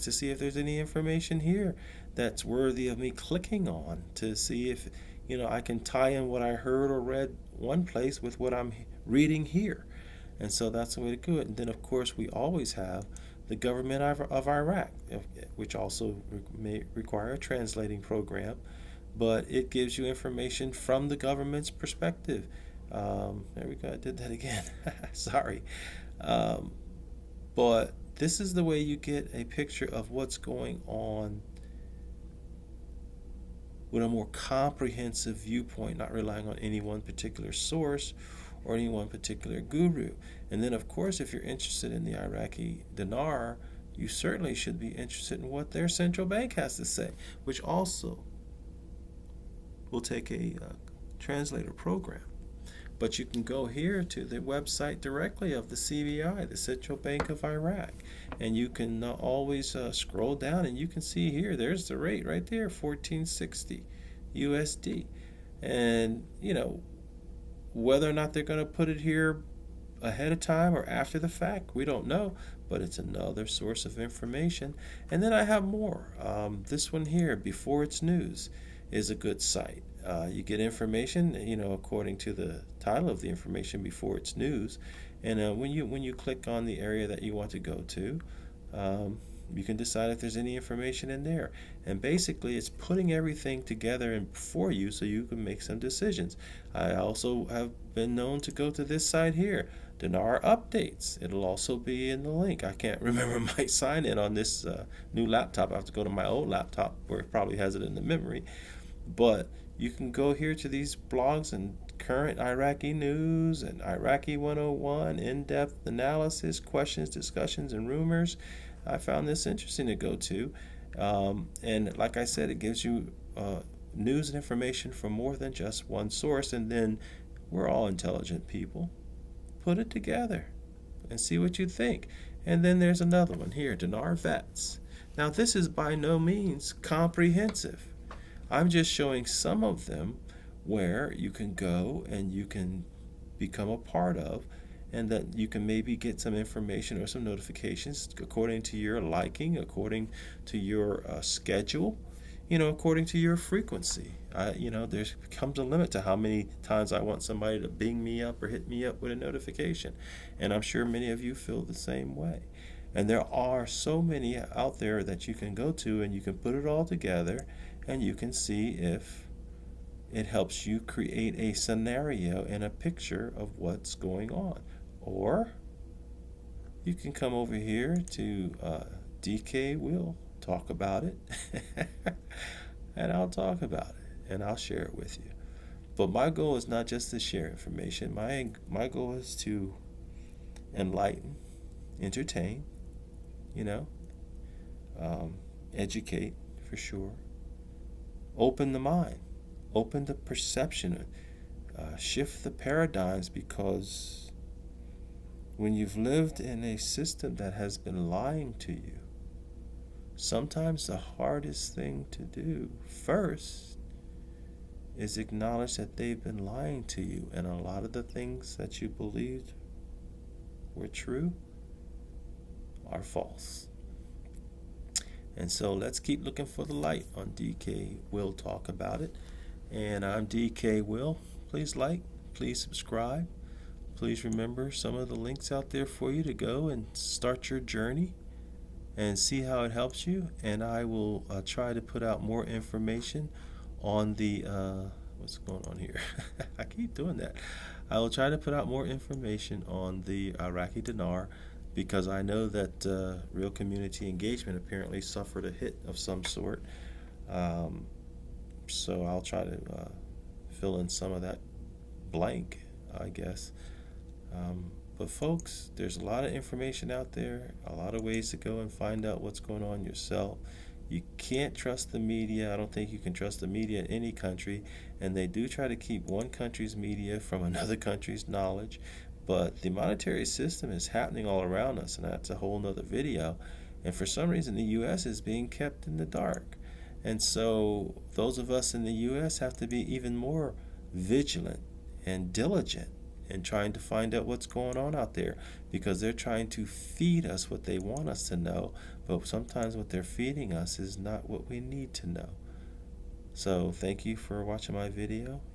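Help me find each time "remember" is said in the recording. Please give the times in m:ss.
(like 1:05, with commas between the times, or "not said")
1:43, 3:54.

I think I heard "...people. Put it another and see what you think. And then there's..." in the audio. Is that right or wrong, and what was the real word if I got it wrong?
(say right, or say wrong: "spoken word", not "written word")
wrong: "together", not "another".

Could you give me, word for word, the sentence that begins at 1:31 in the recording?
And basically, it's putting everything together and for you so you can make some decisions.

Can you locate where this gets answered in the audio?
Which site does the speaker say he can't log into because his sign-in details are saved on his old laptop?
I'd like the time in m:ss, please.
1:39.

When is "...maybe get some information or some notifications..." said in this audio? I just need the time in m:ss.
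2:25.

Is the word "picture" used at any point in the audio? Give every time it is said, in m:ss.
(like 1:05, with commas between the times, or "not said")
0:29, 2:52.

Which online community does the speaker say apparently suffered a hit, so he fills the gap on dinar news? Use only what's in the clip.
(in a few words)
real community engagement.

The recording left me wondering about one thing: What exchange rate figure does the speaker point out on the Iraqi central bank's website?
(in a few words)
1460 USD.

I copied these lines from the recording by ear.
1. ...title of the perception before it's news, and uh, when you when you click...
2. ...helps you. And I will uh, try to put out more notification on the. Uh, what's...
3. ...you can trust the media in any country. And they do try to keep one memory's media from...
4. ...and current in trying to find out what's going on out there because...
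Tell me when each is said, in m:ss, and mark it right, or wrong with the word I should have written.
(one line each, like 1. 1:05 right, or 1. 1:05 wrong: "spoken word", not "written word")
1. 1:22 wrong: "information", not "perception"
2. 3:59 wrong: "information", not "notification"
3. 4:32 wrong: "country", not "memory"
4. 4:52 wrong: "diligent", not "current".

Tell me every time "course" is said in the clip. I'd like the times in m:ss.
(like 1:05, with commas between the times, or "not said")
0:11, 0:40.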